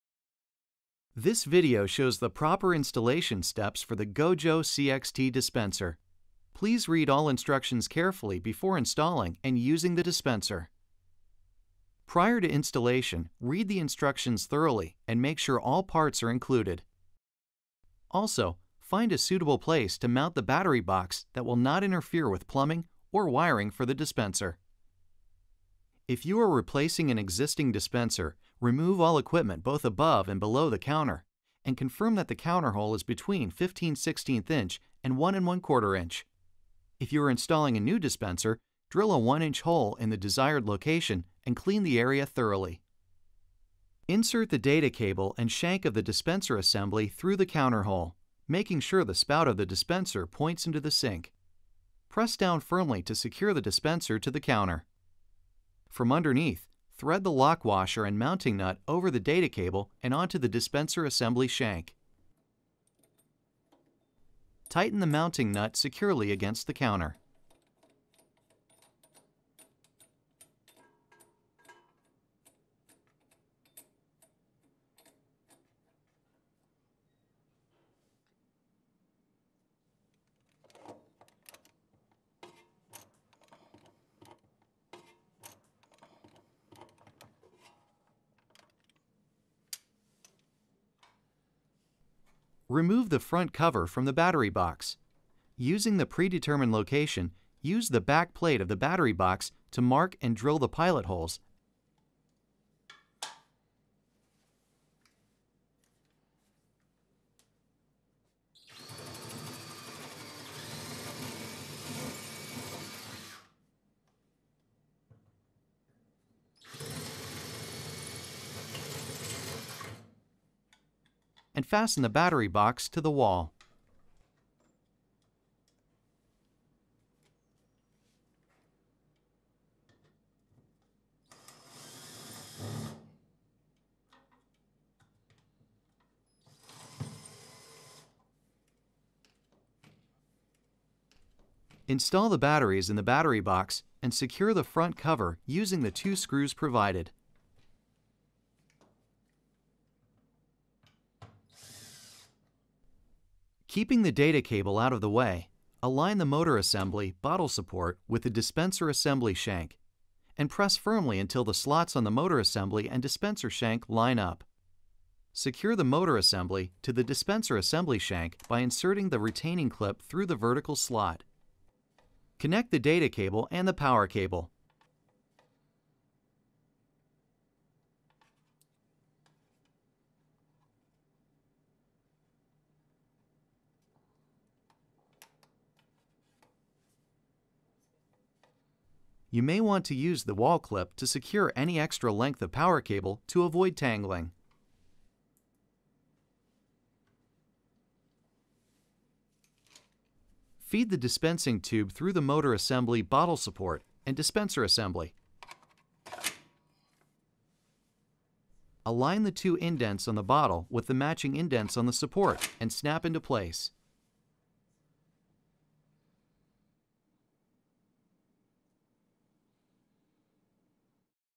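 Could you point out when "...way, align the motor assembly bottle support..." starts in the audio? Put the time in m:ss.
2:35.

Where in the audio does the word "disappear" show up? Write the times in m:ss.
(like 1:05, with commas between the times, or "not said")
not said.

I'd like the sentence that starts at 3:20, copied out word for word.
Feed the dispensing tube through the motor assembly bottle support and dispenser assembly.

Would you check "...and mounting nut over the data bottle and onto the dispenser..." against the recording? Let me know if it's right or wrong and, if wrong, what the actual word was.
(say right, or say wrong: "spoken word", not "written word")
wrong: "cable", not "bottle".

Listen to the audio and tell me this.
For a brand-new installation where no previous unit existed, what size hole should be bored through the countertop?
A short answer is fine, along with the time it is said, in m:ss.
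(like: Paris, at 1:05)
1 inch, at 0:39.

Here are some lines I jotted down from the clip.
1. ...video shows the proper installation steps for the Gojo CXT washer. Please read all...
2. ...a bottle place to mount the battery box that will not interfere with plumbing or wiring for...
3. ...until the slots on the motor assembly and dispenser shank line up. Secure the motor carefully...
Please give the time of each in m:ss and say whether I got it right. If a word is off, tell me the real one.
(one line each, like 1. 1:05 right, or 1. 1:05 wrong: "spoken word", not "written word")
1. 0:01 wrong: "dispenser", not "washer"
2. 0:19 wrong: "suitable", not "bottle"
3. 2:41 wrong: "assembly", not "carefully".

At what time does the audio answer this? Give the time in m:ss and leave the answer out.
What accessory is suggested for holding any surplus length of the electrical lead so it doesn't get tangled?
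3:10.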